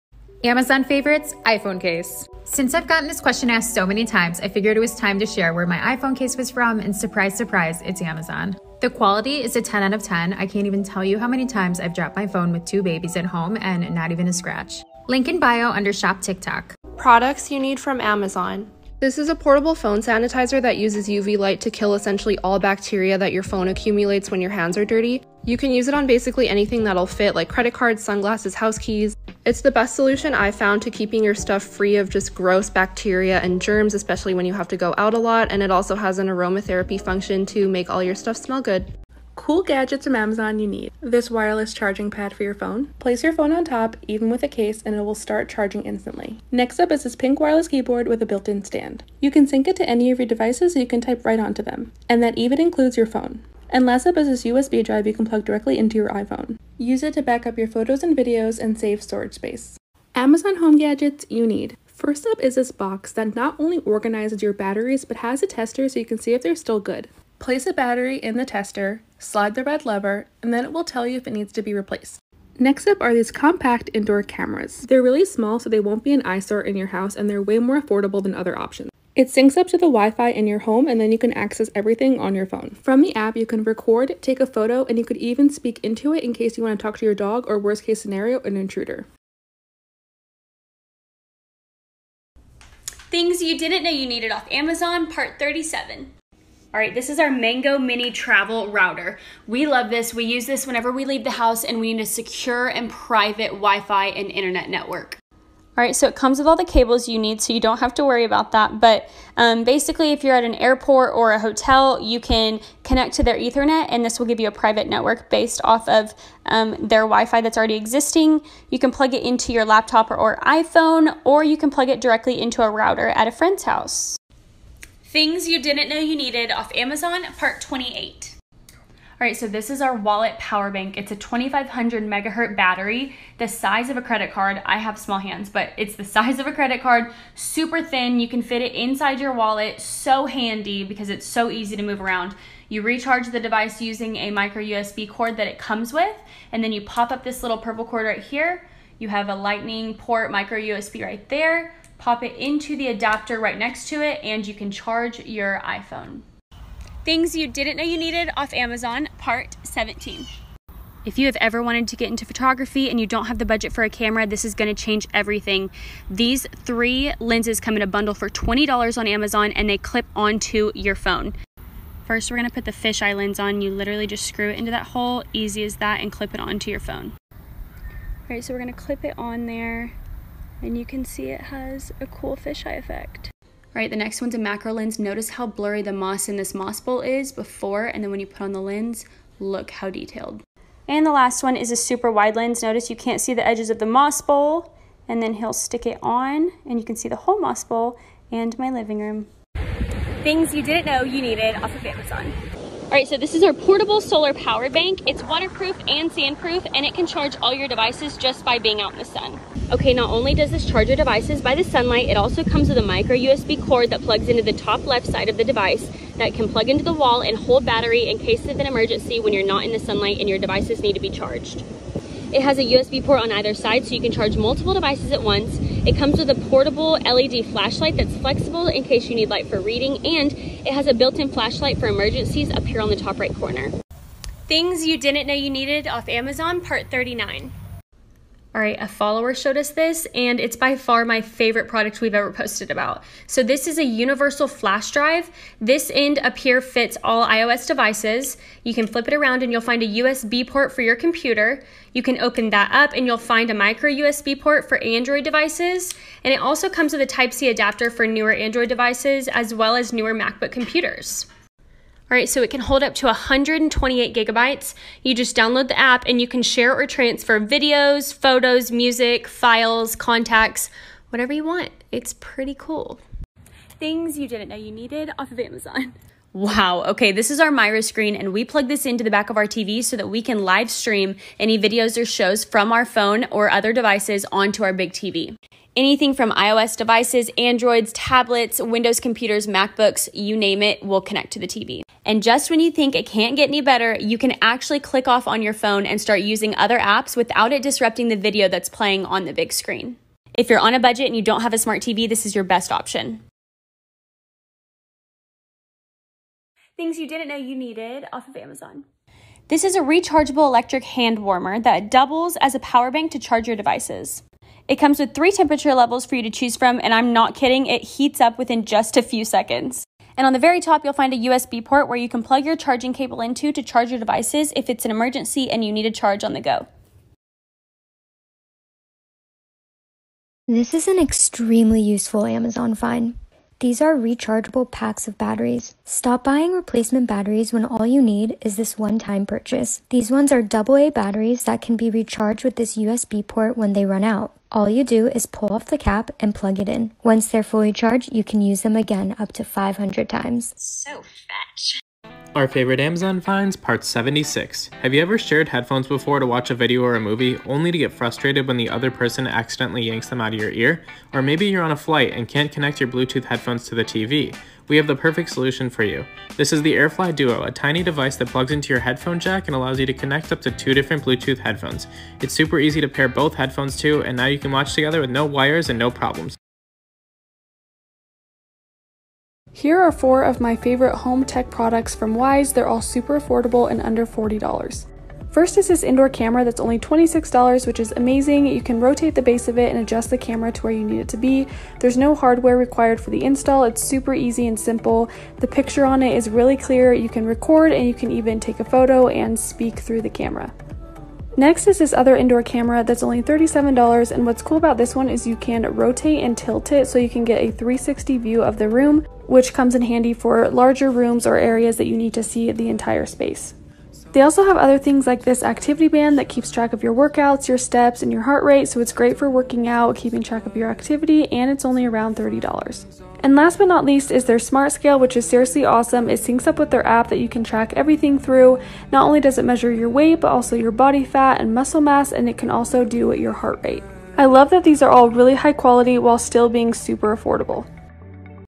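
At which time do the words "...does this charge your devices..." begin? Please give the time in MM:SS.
03:30.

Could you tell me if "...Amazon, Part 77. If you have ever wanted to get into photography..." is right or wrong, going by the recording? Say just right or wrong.
wrong.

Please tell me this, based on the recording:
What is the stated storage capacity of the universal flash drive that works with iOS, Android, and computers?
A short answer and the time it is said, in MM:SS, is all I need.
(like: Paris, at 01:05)
128 gigabytes, at 04:23.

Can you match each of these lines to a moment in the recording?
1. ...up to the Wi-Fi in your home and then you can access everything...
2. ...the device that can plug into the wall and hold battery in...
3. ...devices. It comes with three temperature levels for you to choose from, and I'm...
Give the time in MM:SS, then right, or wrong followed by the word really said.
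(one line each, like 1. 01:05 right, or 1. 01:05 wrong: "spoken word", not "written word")
1. 01:19 right
2. 03:35 right
3. 05:13 right.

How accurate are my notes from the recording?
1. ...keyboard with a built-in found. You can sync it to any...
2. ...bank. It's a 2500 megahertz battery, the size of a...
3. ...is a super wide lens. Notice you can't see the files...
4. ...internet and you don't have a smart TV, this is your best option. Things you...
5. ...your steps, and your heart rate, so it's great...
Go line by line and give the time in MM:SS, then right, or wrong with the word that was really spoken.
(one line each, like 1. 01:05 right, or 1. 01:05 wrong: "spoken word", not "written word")
1. 00:47 wrong: "stand", not "found"
2. 02:10 right
3. 03:11 wrong: "edges", not "files"
4. 05:00 wrong: "budget", not "internet"
5. 06:57 right.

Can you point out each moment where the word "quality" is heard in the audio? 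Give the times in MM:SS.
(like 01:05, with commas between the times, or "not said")
00:08, 07:15.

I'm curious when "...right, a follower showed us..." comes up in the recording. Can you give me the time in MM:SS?
03:58.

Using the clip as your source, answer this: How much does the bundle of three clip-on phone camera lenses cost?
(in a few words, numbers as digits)
$20.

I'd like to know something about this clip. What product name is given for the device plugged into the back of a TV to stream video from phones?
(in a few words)
MiraScreen.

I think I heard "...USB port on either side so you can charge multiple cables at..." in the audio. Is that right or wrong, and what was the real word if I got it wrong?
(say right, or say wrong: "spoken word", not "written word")
wrong: "devices", not "cables".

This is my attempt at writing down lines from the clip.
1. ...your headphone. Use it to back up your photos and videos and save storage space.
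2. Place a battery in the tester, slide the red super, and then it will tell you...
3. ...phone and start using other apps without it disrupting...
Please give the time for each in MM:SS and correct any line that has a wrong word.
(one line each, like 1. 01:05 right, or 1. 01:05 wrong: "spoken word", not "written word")
1. 00:55 wrong: "iPhone", not "headphone"
2. 01:07 wrong: "lever", not "super"
3. 04:55 right.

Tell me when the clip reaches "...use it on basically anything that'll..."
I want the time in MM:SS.
00:25.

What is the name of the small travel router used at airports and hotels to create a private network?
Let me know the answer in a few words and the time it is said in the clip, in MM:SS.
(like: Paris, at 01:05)
Mango Mini Travel Router, at 01:37.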